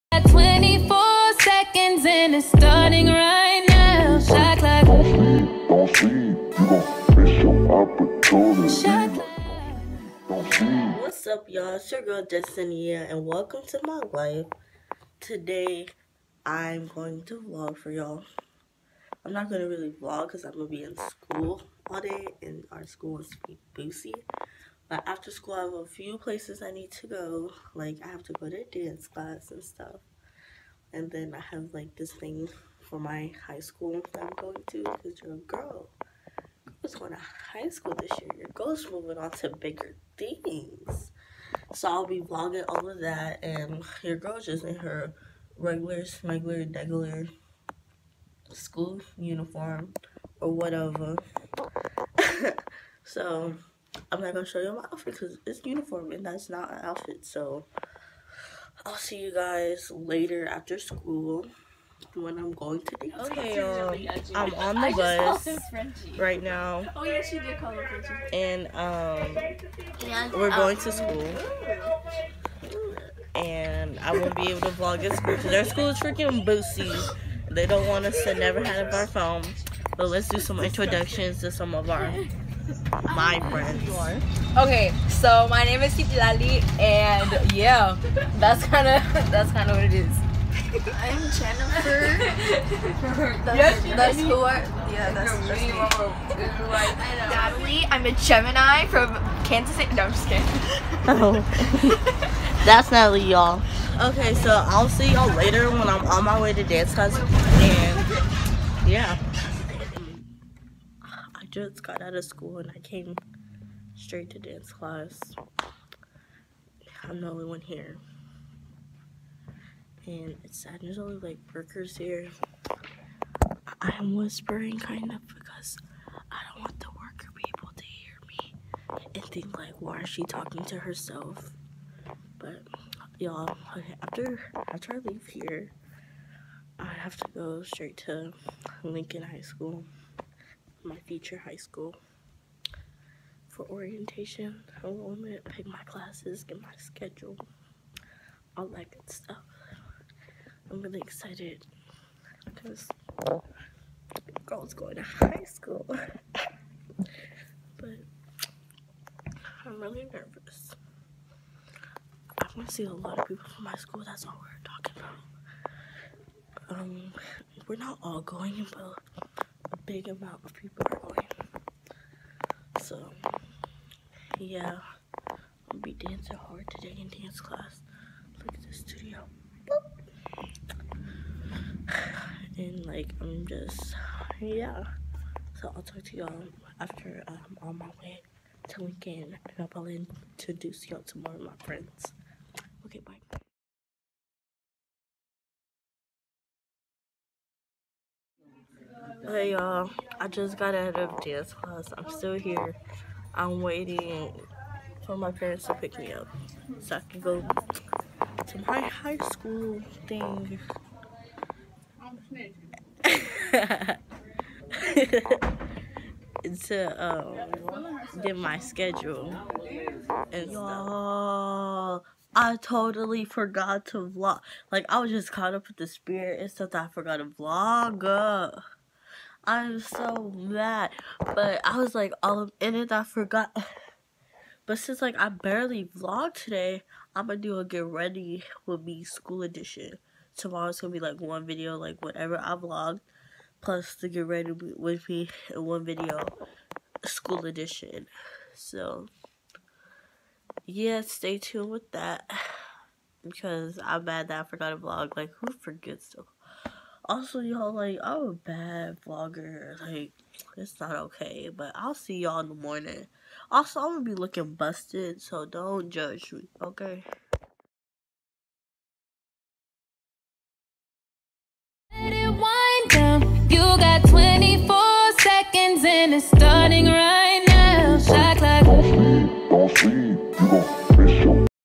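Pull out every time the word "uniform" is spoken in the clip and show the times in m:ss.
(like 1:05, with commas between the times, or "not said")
0:49, 0:55.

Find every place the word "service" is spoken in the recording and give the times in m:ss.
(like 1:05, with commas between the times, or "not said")
not said.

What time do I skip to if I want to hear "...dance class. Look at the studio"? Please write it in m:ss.
2:57.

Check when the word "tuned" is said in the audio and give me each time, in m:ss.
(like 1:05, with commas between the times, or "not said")
4:11.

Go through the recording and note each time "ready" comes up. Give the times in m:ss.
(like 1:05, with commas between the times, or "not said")
3:57, 4:04.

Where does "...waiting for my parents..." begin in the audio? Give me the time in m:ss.
3:23.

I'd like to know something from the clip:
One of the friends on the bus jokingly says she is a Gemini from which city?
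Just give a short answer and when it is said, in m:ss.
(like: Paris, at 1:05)
Kansas City, at 1:39.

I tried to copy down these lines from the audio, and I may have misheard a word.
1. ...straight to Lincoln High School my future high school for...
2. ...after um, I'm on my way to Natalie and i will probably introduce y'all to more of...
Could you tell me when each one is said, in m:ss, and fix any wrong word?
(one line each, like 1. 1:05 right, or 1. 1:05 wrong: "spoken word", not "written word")
1. 2:17 right
2. 3:06 wrong: "Lincoln", not "Natalie".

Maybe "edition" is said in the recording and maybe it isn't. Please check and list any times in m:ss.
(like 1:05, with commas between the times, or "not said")
3:59, 4:07.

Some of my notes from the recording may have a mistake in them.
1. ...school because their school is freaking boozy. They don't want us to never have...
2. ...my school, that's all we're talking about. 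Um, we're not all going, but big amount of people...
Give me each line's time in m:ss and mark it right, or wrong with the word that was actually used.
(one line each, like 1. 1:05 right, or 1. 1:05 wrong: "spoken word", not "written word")
1. 1:15 right
2. 2:43 right.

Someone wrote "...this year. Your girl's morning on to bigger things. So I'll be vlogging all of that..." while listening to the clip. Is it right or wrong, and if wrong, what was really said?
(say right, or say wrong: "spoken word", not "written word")
wrong: "moving", not "morning".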